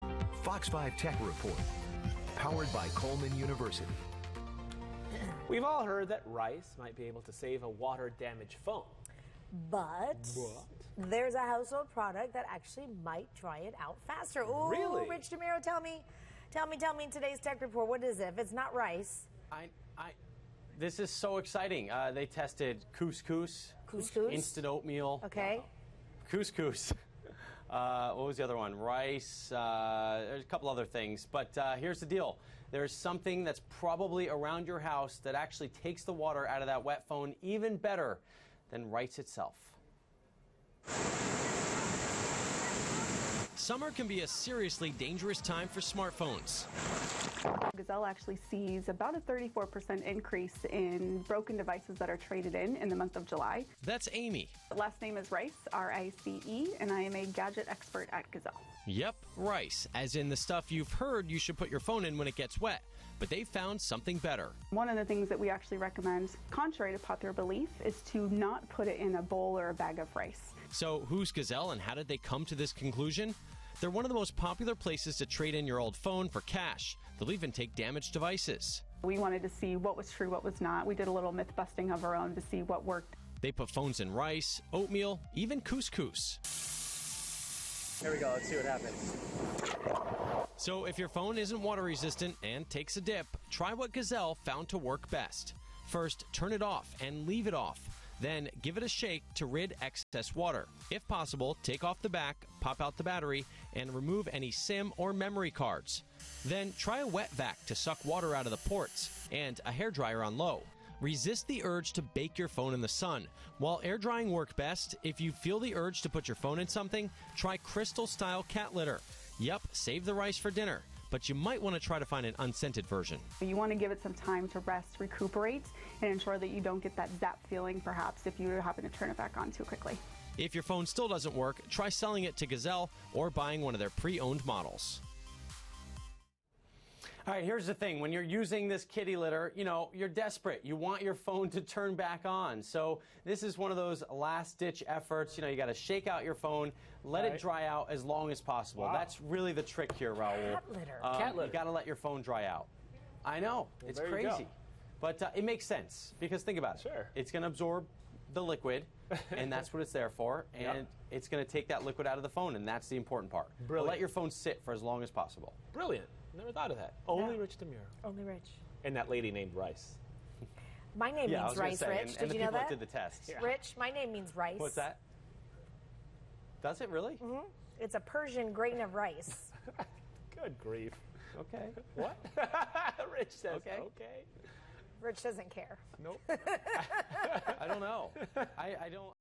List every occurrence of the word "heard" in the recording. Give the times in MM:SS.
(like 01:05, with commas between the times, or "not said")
00:05, 01:00.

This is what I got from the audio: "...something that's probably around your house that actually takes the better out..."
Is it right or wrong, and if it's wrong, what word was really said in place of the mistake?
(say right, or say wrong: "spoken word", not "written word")
wrong: "water", not "better".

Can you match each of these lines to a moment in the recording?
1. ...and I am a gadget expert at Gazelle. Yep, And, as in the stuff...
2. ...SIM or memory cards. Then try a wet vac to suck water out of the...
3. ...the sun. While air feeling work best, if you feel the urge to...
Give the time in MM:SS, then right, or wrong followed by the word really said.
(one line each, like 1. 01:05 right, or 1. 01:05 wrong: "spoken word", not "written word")
1. 00:56 wrong: "Rice", not "And"
2. 01:44 right
3. 01:52 wrong: "drying", not "feeling".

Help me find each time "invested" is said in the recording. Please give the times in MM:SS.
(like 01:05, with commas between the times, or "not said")
not said.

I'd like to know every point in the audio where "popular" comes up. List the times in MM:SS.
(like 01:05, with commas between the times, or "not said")
01:06, 01:14.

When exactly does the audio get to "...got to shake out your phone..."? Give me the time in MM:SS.
02:25.